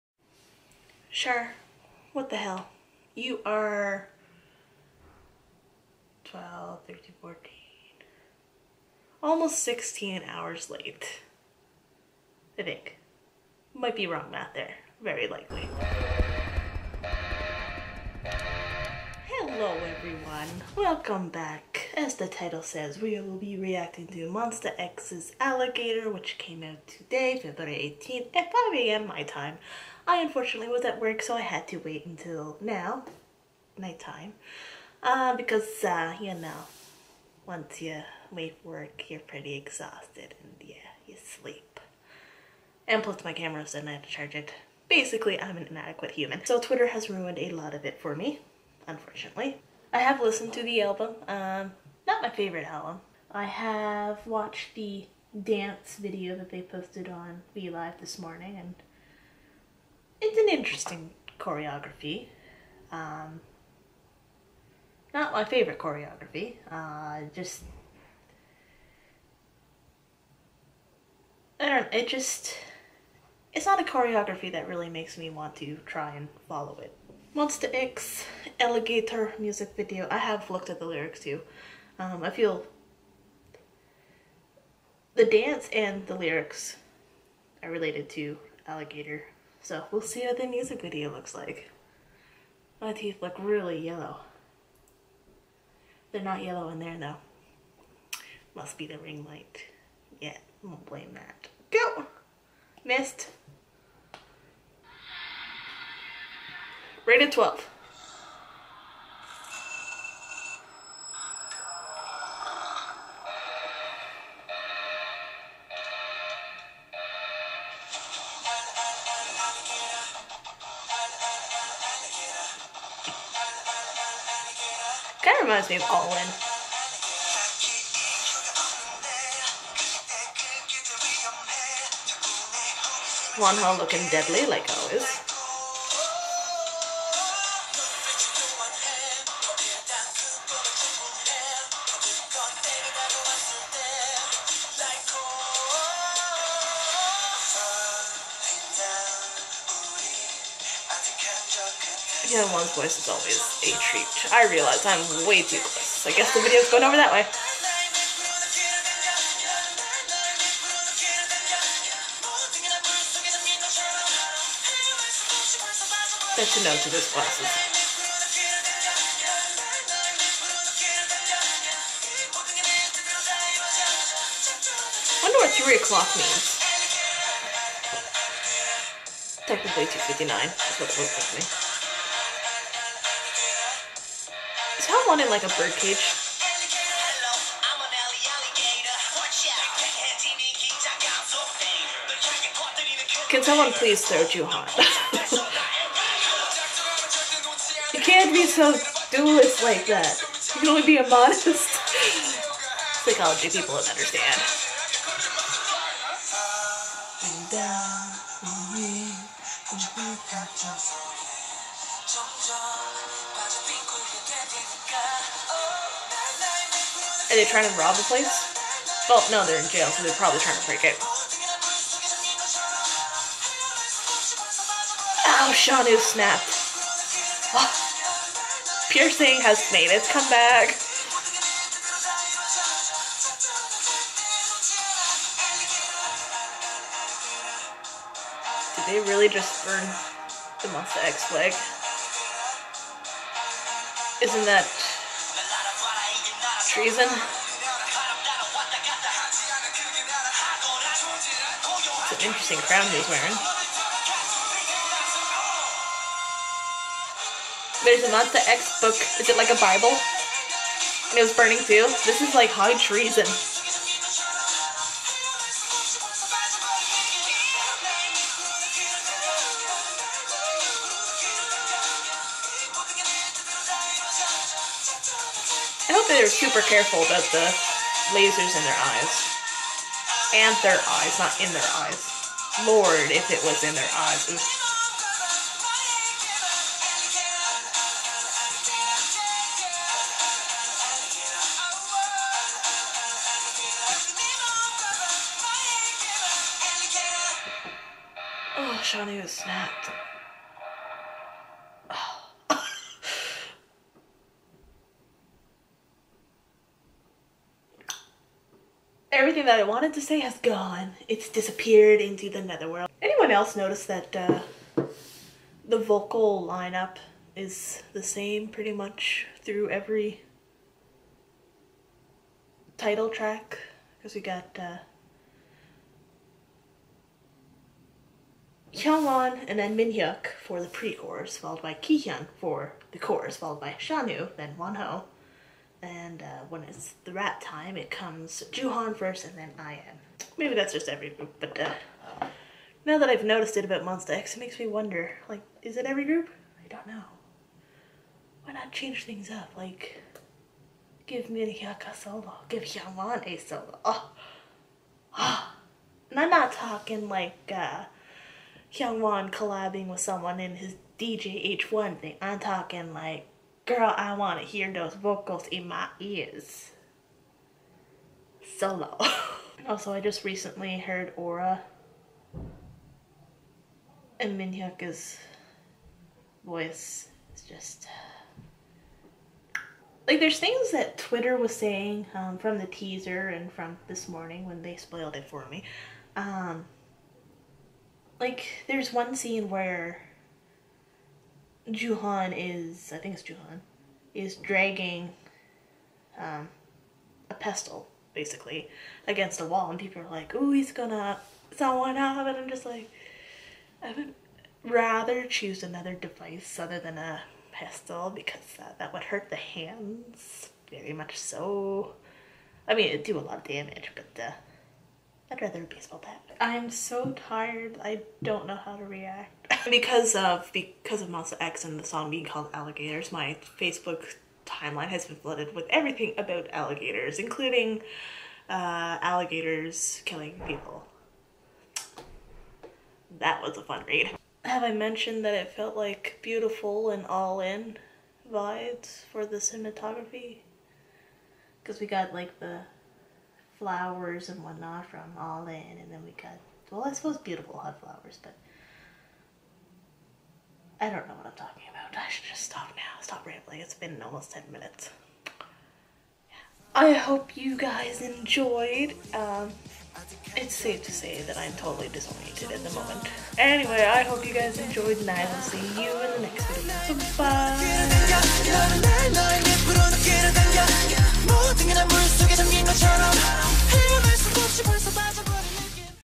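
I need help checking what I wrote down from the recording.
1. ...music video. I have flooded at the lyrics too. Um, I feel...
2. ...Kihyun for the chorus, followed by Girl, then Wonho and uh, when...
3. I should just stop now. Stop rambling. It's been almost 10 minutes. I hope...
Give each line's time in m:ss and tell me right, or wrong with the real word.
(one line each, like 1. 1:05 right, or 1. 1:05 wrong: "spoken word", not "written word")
1. 1:19 wrong: "looked", not "flooded"
2. 5:31 wrong: "Shownu", not "Girl"
3. 7:31 right.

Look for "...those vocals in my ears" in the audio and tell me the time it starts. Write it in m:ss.
6:04.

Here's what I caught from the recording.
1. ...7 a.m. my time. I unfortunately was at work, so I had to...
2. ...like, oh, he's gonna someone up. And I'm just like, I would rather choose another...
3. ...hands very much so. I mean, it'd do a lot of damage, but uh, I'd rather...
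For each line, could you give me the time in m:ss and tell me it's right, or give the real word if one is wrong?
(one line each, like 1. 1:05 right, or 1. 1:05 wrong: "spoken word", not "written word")
1. 0:28 wrong: "5", not "7"
2. 6:40 right
3. 6:49 right.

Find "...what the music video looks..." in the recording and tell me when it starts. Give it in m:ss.
1:30.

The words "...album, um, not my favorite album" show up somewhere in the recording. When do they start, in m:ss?
0:50.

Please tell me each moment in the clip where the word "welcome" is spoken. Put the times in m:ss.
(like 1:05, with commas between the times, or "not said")
0:20.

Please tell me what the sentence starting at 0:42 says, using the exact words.
And plus my camera's and I had to charge it.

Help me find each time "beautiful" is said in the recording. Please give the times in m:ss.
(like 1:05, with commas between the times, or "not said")
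7:16, 7:27.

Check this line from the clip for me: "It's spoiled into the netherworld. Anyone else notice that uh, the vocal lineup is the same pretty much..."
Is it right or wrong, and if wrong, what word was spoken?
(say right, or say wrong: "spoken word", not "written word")
wrong: "disappeared", not "spoiled".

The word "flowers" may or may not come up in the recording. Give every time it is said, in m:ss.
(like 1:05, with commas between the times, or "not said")
7:23, 7:27.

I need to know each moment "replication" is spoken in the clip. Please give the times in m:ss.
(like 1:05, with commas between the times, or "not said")
not said.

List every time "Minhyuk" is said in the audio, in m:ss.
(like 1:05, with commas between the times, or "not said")
5:29, 6:14.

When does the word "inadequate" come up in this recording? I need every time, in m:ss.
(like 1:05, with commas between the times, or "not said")
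0:45.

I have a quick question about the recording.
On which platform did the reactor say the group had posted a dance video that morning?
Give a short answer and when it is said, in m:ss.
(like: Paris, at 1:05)
VLive, at 0:57.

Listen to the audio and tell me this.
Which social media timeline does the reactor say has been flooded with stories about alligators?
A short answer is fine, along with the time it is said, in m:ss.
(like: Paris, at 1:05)
Facebook, at 7:03.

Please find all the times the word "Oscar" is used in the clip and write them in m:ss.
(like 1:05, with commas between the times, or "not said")
not said.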